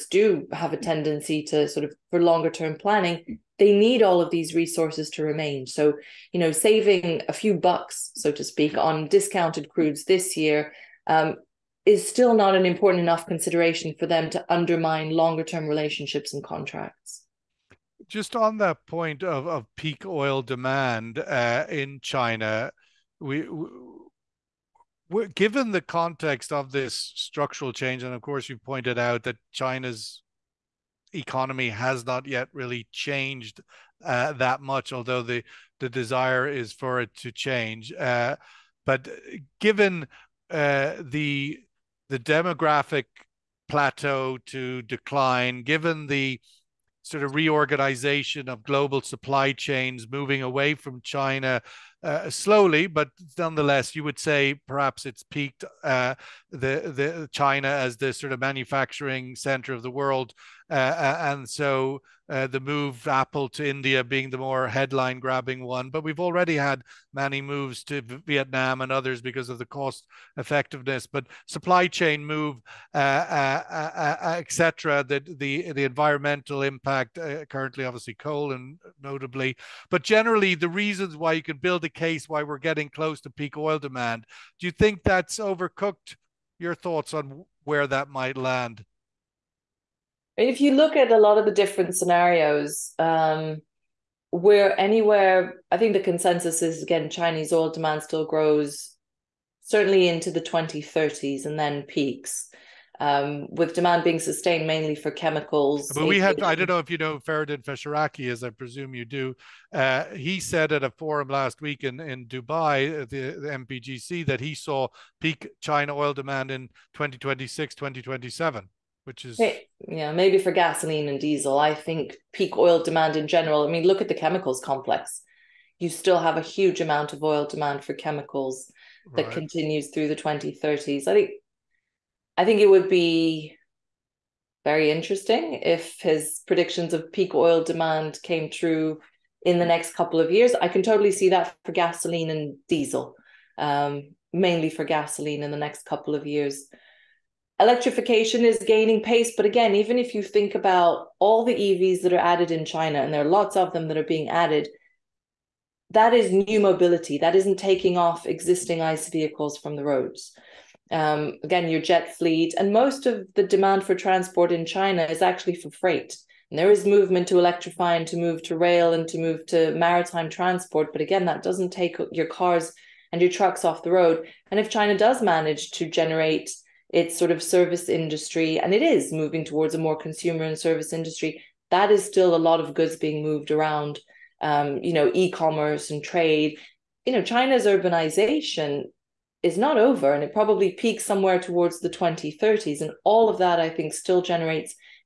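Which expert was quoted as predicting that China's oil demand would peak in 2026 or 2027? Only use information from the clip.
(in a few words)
Feridun Fesharaki.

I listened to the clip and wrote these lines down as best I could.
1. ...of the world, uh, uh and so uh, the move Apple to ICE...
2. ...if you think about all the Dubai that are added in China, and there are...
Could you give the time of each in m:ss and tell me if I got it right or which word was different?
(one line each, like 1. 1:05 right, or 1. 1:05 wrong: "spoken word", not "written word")
1. 0:59 wrong: "India", not "ICE"
2. 2:29 wrong: "EVs", not "Dubai".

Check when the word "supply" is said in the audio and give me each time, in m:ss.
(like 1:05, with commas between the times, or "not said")
0:48, 1:11.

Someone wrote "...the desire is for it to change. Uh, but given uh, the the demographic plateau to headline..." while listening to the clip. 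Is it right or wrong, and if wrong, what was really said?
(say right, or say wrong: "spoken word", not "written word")
wrong: "decline", not "headline".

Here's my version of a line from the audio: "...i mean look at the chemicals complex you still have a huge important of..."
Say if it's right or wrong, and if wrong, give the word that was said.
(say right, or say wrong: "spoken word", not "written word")
wrong: "amount", not "important".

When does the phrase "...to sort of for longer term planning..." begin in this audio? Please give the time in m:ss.
0:01.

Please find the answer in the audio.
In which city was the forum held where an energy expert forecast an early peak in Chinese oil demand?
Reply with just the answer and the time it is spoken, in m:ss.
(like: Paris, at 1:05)
Dubai, at 1:52.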